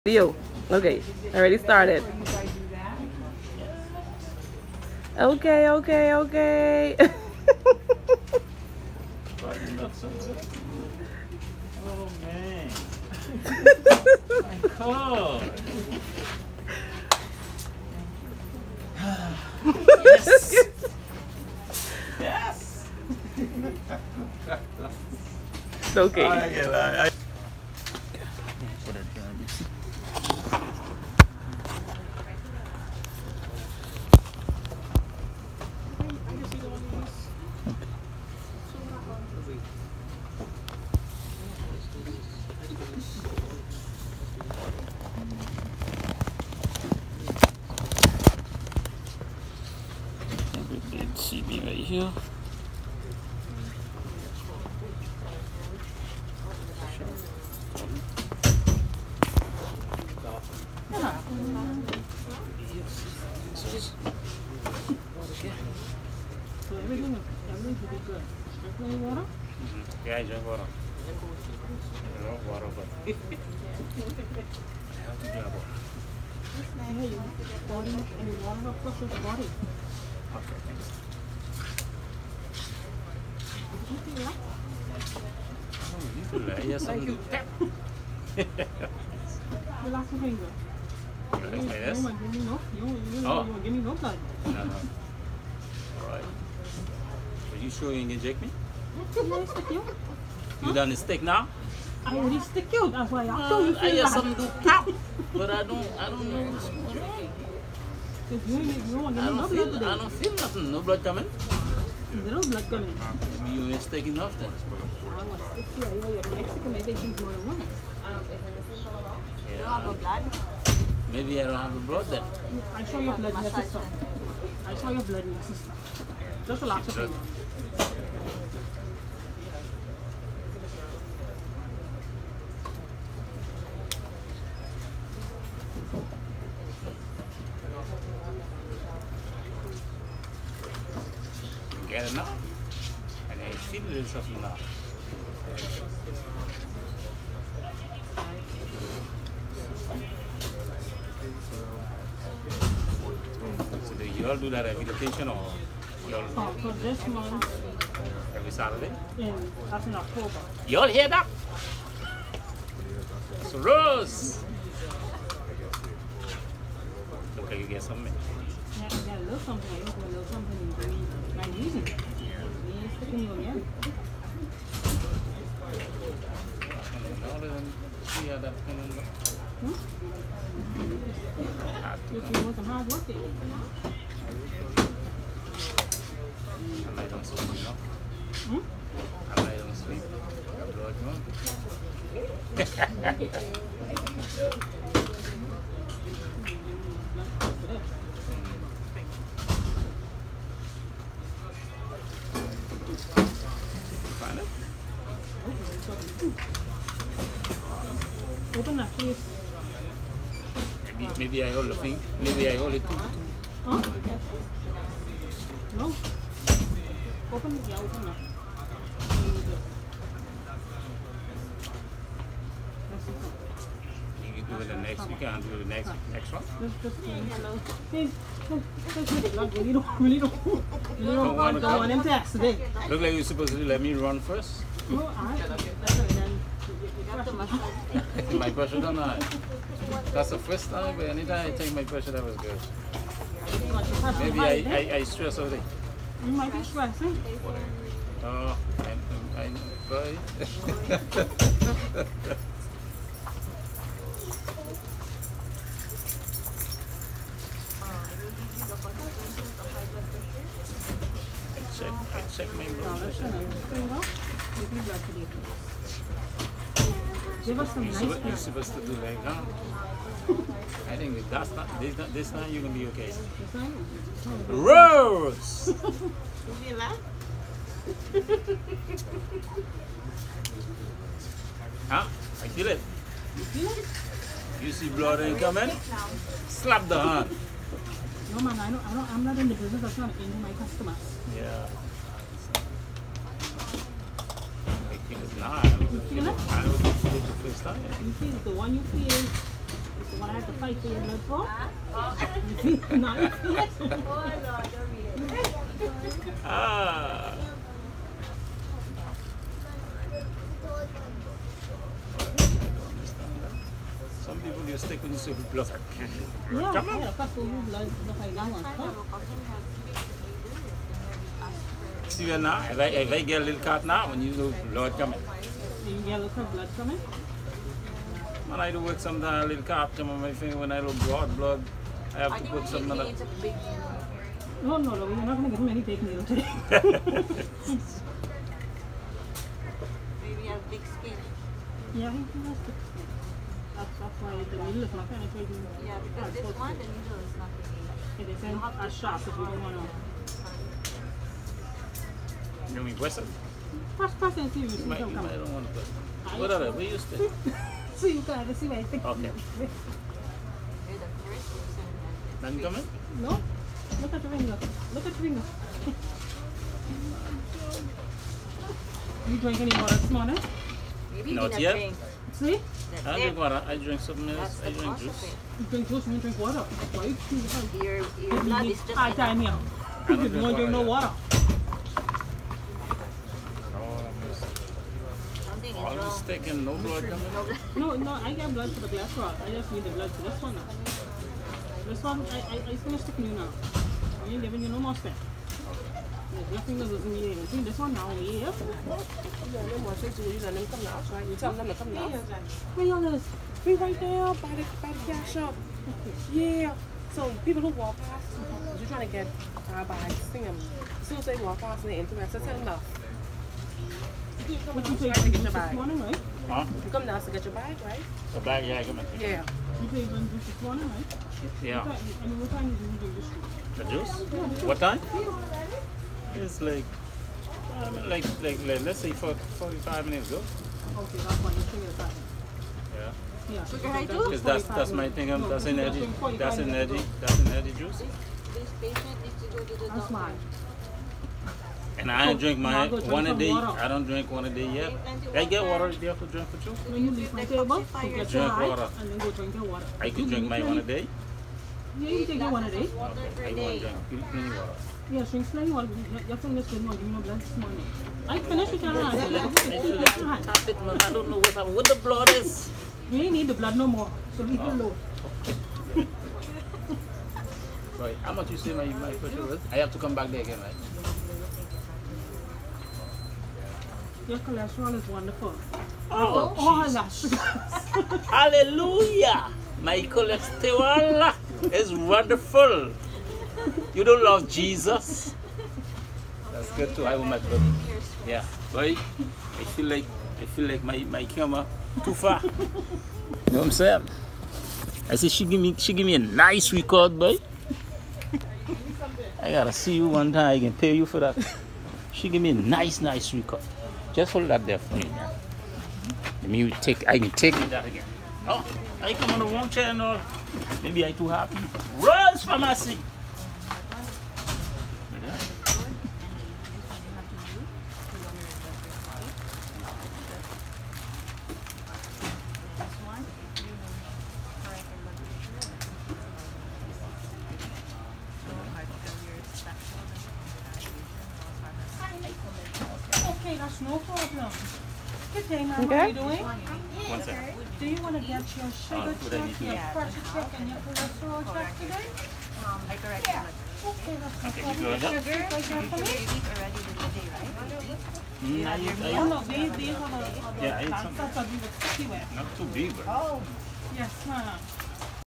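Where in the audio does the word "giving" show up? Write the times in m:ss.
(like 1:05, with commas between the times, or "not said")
6:34.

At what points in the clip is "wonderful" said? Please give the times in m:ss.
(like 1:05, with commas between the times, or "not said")
7:55, 8:01.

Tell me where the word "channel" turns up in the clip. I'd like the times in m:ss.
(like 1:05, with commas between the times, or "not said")
8:29.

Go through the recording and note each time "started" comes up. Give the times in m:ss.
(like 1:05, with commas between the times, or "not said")
0:01.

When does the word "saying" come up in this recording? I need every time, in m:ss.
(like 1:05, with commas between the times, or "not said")
8:13.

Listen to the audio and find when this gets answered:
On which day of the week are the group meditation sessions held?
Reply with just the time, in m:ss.
2:38.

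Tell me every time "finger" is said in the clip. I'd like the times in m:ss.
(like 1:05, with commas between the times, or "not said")
5:30, 7:36.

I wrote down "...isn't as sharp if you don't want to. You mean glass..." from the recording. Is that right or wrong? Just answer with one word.
wrong.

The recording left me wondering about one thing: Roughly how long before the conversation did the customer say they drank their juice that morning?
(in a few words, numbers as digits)
45 minutes ago.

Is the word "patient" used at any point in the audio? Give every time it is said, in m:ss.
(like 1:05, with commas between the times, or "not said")
7:18.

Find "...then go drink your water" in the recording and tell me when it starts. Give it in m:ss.
7:29.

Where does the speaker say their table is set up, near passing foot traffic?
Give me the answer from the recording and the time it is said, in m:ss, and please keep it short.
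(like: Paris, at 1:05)
By the cash shop, at 6:44.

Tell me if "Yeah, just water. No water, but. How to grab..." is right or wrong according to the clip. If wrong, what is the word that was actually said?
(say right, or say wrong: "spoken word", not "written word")
right.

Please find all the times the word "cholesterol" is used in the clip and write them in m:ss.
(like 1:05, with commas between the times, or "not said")
7:54, 8:00, 9:00.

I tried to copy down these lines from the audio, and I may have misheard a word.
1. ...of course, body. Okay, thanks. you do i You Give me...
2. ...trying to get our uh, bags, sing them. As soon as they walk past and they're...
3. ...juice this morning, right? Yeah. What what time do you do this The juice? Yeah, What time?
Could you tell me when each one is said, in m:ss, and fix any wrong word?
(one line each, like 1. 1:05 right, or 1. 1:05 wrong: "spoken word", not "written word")
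1. 1:18 right
2. 6:48 right
3. 7:00 right.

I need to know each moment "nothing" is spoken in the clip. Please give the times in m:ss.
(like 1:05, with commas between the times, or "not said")
1:50, 6:36.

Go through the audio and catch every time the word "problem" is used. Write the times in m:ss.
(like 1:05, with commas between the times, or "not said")
8:53, 9:04.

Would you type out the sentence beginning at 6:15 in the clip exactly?
You drink juice, you drink water.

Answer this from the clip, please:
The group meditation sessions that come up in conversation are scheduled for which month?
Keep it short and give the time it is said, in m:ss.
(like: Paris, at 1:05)
October, at 2:39.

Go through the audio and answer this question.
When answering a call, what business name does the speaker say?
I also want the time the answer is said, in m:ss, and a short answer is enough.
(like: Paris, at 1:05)
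Lowe's Pharmacy, at 8:31.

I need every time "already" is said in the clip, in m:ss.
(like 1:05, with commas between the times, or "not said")
0:01, 1:42, 9:05.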